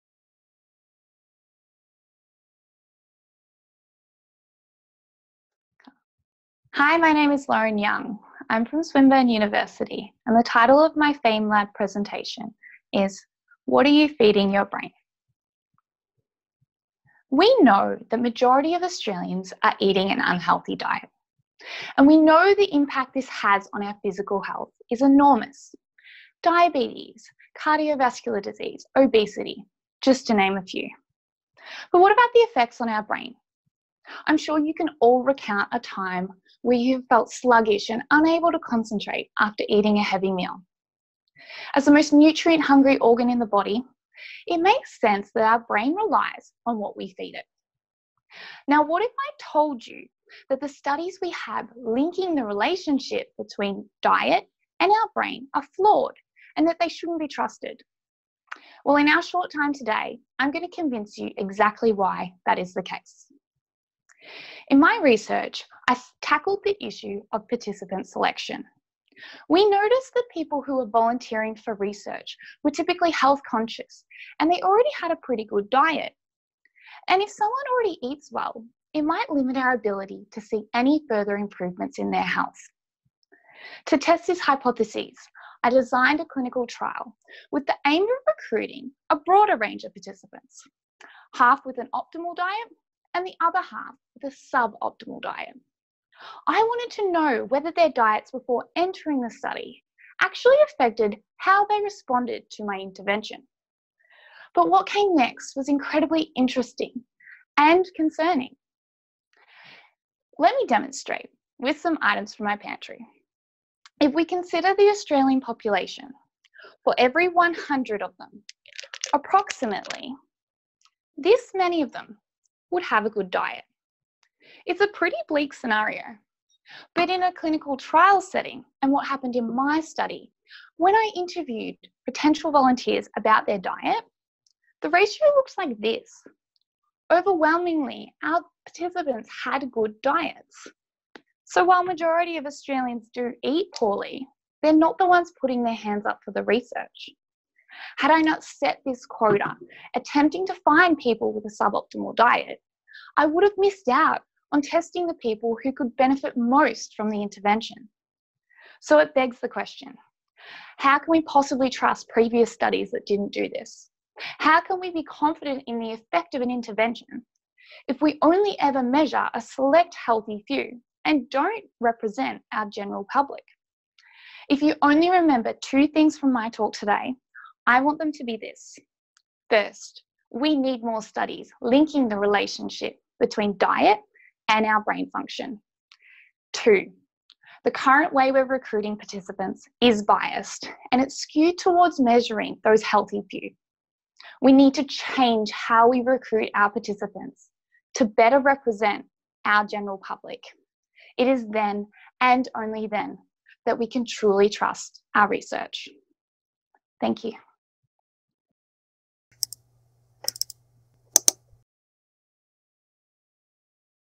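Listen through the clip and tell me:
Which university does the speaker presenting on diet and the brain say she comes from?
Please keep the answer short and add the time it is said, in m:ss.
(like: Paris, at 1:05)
Swinburne University, at 0:08.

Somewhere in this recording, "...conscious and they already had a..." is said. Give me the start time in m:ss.
1:13.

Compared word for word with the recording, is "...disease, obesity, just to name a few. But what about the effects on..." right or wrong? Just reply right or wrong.
right.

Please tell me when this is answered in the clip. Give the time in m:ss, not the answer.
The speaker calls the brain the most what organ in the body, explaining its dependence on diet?
0:42.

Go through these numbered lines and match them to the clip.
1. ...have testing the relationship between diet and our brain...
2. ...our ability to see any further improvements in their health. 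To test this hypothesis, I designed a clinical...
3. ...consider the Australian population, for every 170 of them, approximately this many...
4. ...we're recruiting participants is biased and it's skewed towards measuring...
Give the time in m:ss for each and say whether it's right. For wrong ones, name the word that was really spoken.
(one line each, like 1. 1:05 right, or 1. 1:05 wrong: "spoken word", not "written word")
1. 0:51 wrong: "linking", not "testing"
2. 1:19 right
3. 1:54 wrong: "100", not "170"
4. 3:08 right.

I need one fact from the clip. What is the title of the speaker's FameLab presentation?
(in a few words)
What Are You Feeding Your Brain?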